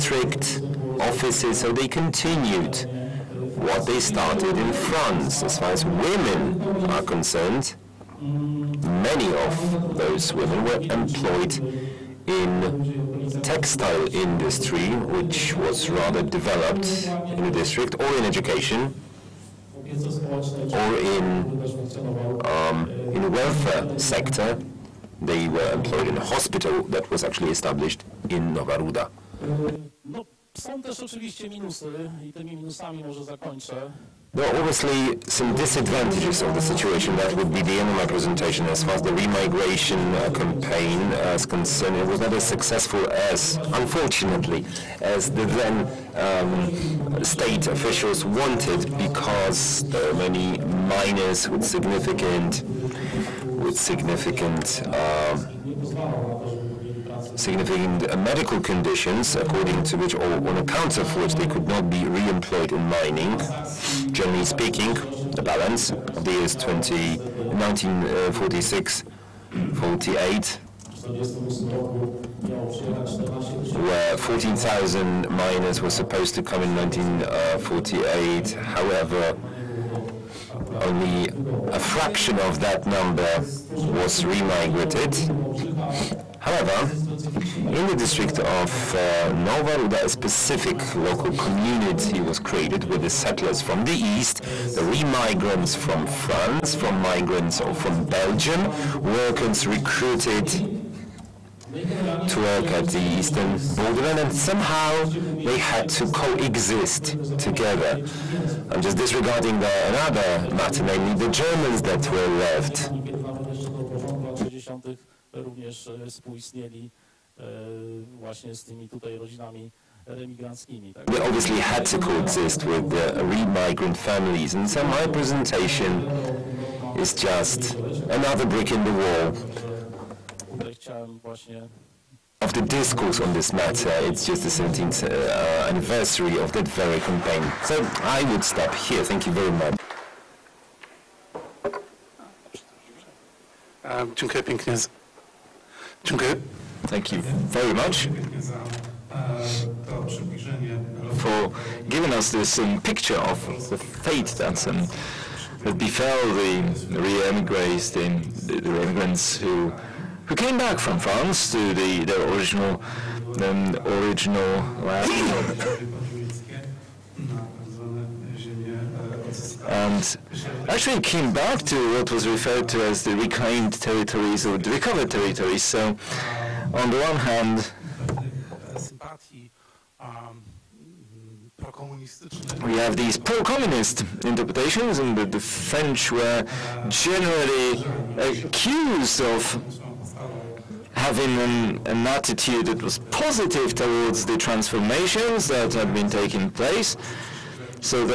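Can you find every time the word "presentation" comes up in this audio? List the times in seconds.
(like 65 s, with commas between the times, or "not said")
38 s, 125 s.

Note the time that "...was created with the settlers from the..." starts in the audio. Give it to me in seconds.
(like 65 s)
92 s.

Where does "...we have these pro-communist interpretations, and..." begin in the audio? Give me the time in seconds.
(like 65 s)
182 s.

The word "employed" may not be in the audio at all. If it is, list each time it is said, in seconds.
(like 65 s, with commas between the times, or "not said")
10 s, 25 s, 62 s.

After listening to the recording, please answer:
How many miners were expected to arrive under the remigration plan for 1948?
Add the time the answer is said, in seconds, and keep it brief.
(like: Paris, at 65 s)
14,000, at 74 s.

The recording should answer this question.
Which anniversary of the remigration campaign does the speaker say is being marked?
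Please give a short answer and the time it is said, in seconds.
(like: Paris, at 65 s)
17th, at 134 s.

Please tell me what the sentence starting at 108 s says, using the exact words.
I'm just disregarding the, another matter, namely the Germans that were left.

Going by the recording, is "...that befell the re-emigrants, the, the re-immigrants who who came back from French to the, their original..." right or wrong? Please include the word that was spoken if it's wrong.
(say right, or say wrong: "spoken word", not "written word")
wrong: "France", not "French".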